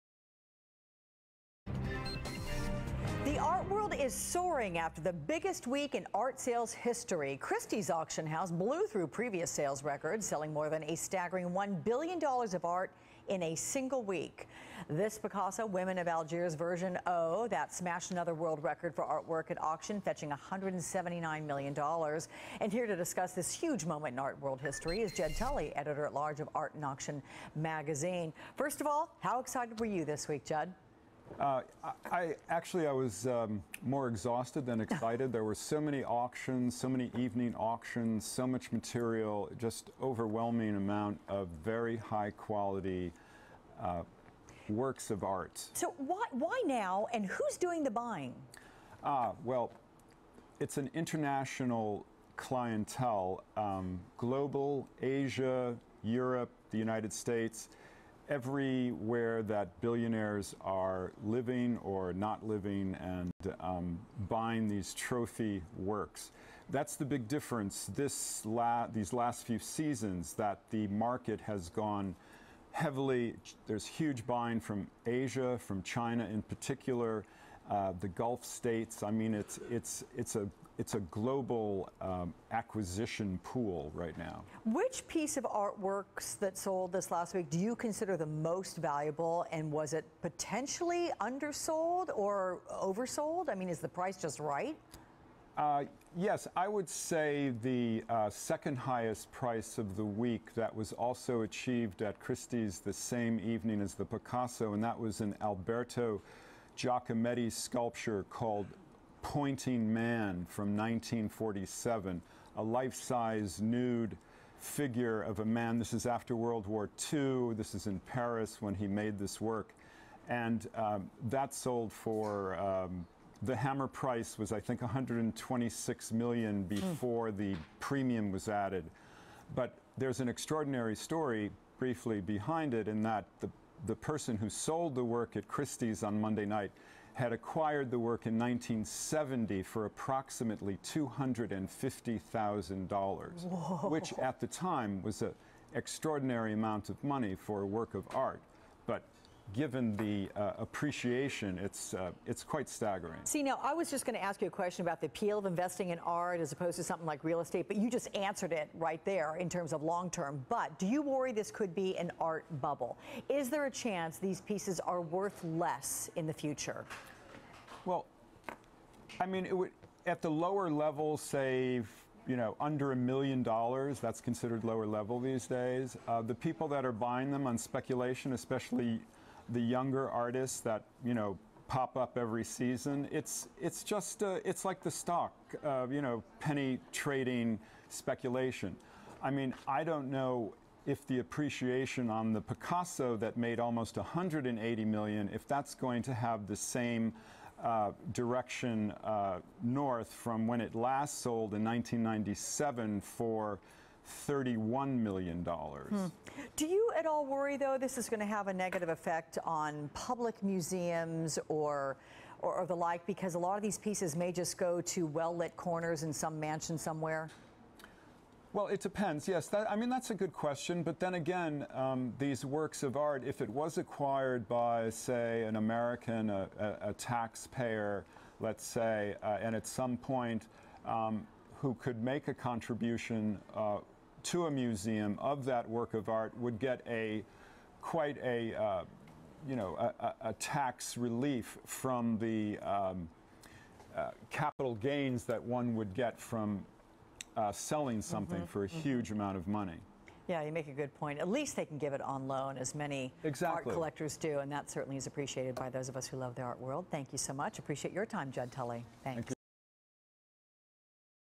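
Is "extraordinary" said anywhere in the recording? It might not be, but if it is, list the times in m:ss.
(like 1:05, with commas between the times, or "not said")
2:10, 2:25.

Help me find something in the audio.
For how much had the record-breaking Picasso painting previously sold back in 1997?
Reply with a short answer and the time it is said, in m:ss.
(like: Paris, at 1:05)
$31 million, at 3:24.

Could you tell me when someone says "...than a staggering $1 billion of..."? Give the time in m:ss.
0:10.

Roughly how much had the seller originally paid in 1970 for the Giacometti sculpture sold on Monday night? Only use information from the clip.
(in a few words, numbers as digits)
$250,000.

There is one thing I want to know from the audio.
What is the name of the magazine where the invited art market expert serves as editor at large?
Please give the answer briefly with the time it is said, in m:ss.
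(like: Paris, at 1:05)
Art and Auction, at 0:26.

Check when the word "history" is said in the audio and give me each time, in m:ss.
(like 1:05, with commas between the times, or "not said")
0:06, 0:24.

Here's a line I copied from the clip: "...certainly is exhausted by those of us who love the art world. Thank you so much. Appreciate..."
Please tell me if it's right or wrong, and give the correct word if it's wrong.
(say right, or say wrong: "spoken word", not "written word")
wrong: "appreciated", not "exhausted".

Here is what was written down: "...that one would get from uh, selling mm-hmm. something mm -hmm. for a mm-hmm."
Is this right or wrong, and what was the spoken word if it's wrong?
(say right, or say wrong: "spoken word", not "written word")
right.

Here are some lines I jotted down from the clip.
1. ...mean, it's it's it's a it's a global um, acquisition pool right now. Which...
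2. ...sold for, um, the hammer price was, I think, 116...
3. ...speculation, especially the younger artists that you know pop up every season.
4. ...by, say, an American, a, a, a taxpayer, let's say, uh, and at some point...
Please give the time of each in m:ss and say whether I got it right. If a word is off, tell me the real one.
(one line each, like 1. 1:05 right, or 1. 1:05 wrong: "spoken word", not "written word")
1. 1:19 right
2. 2:01 wrong: "126", not "116"
3. 2:57 right
4. 3:44 right.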